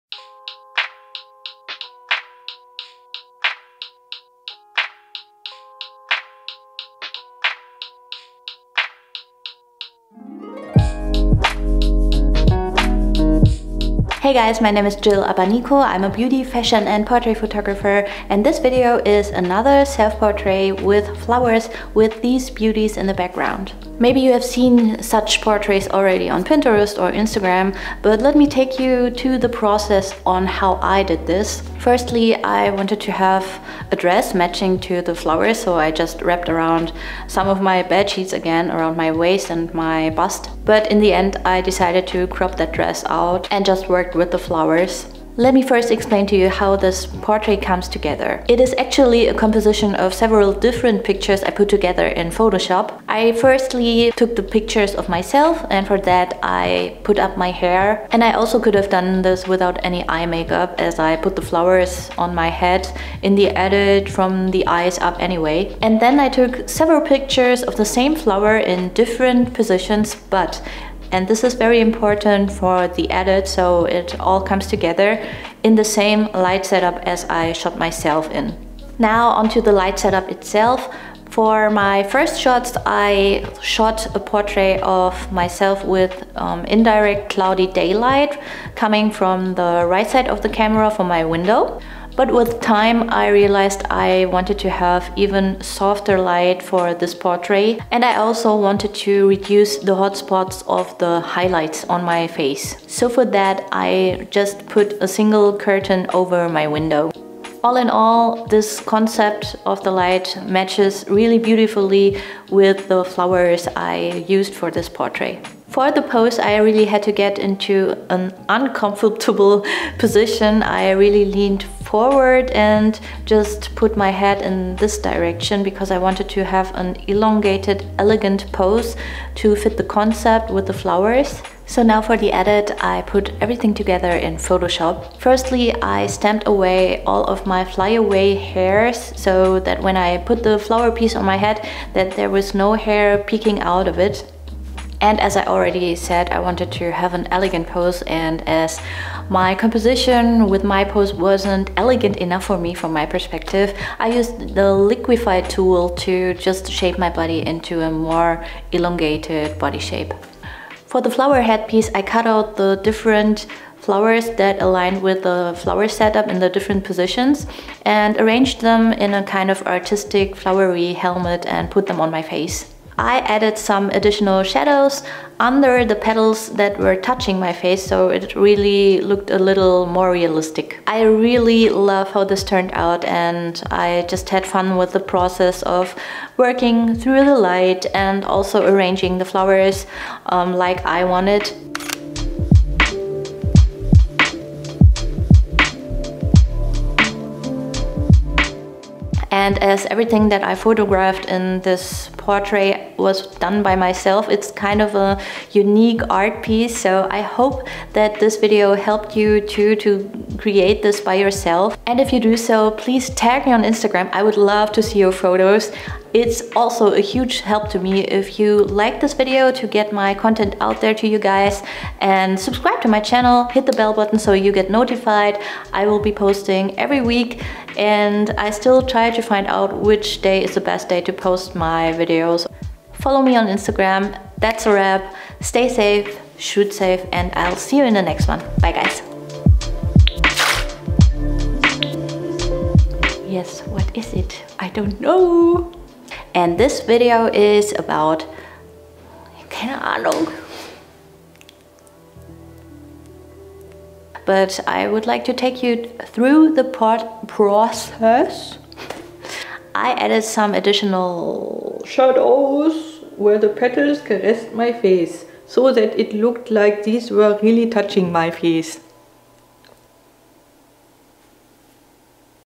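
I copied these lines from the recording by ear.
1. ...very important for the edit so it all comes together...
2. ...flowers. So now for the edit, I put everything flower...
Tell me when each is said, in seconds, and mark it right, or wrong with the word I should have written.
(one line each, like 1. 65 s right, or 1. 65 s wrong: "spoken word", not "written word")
1. 71 s right
2. 130 s wrong: "together", not "flower".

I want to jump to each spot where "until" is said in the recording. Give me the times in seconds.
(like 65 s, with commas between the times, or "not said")
not said.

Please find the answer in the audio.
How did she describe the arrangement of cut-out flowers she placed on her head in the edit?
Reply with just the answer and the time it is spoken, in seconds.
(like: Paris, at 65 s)
artistic flowery helmet, at 169 s.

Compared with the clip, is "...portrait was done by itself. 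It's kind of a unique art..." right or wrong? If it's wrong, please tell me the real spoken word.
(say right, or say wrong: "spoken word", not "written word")
wrong: "myself", not "itself".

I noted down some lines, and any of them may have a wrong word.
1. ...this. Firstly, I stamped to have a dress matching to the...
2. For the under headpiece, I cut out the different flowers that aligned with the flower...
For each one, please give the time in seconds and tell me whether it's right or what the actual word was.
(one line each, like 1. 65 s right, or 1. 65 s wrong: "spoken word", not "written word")
1. 31 s wrong: "wanted", not "stamped"
2. 160 s wrong: "flower", not "under".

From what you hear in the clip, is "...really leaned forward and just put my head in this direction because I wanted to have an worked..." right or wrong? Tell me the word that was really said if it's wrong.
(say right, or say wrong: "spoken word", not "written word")
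wrong: "elongated", not "worked".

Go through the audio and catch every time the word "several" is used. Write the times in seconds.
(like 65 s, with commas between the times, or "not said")
50 s, 66 s.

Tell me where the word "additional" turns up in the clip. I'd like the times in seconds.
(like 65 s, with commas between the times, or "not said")
173 s, 260 s.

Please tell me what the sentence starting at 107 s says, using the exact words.
All in all, this concept of the light matches really beautifully with the flowers I used for this portrait.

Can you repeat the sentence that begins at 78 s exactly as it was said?
Now onto the light setup itself.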